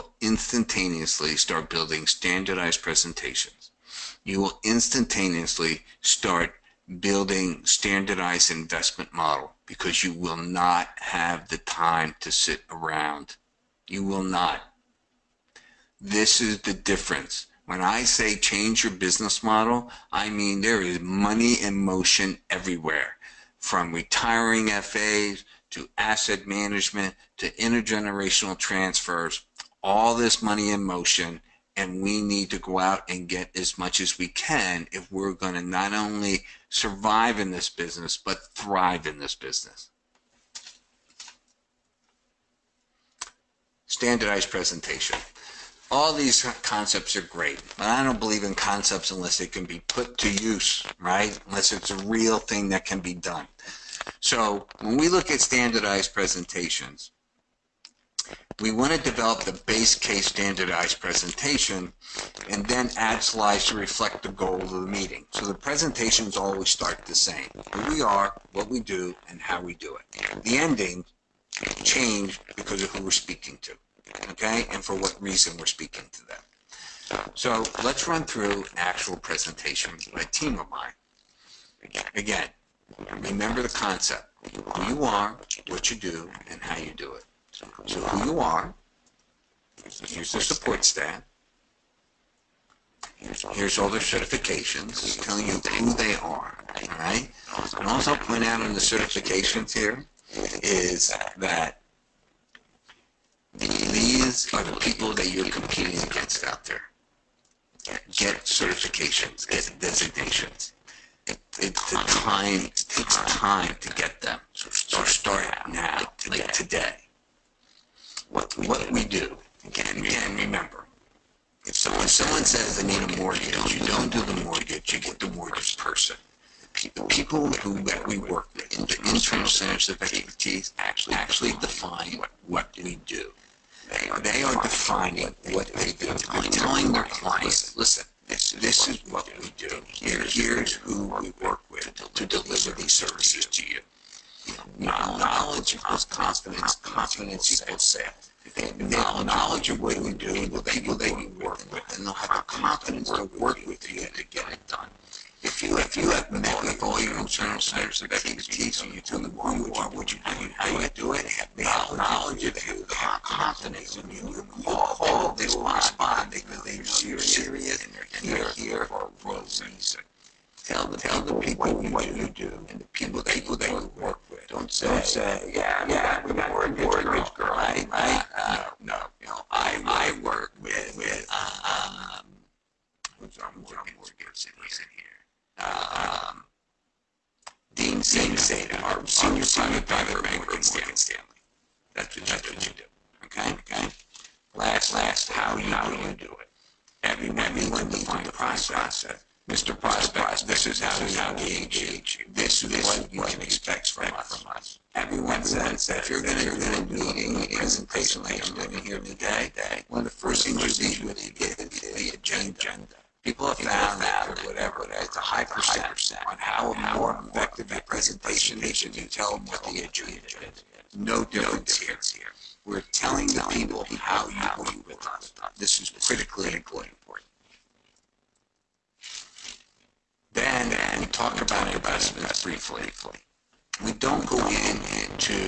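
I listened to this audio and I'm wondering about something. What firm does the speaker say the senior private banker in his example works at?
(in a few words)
Morgan Stanley.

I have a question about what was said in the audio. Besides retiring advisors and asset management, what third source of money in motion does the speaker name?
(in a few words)
intergenerational transfers.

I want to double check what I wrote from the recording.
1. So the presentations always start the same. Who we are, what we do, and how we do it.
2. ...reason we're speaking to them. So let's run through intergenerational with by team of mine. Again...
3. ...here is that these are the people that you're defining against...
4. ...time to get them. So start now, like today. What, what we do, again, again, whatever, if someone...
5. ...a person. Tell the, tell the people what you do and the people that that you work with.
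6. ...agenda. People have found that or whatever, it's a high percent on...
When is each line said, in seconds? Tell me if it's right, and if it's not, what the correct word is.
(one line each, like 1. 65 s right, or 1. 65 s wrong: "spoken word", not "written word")
1. 65 s right
2. 75 s wrong: "actual", not "intergenerational"
3. 99 s wrong: "competing", not "defining"
4. 113 s wrong: "remember", not "whatever"
5. 169 s wrong: "reason", not "person"
6. 212 s right.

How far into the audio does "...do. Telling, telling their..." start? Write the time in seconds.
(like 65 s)
135 s.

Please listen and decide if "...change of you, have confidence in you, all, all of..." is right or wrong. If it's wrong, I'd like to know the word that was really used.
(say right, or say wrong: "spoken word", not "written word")
wrong: "knowledge", not "change".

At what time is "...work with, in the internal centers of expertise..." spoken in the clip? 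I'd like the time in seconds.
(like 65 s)
128 s.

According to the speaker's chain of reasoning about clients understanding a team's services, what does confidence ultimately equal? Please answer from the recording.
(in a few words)
sales.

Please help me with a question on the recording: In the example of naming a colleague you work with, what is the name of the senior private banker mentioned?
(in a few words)
Dean Zeta.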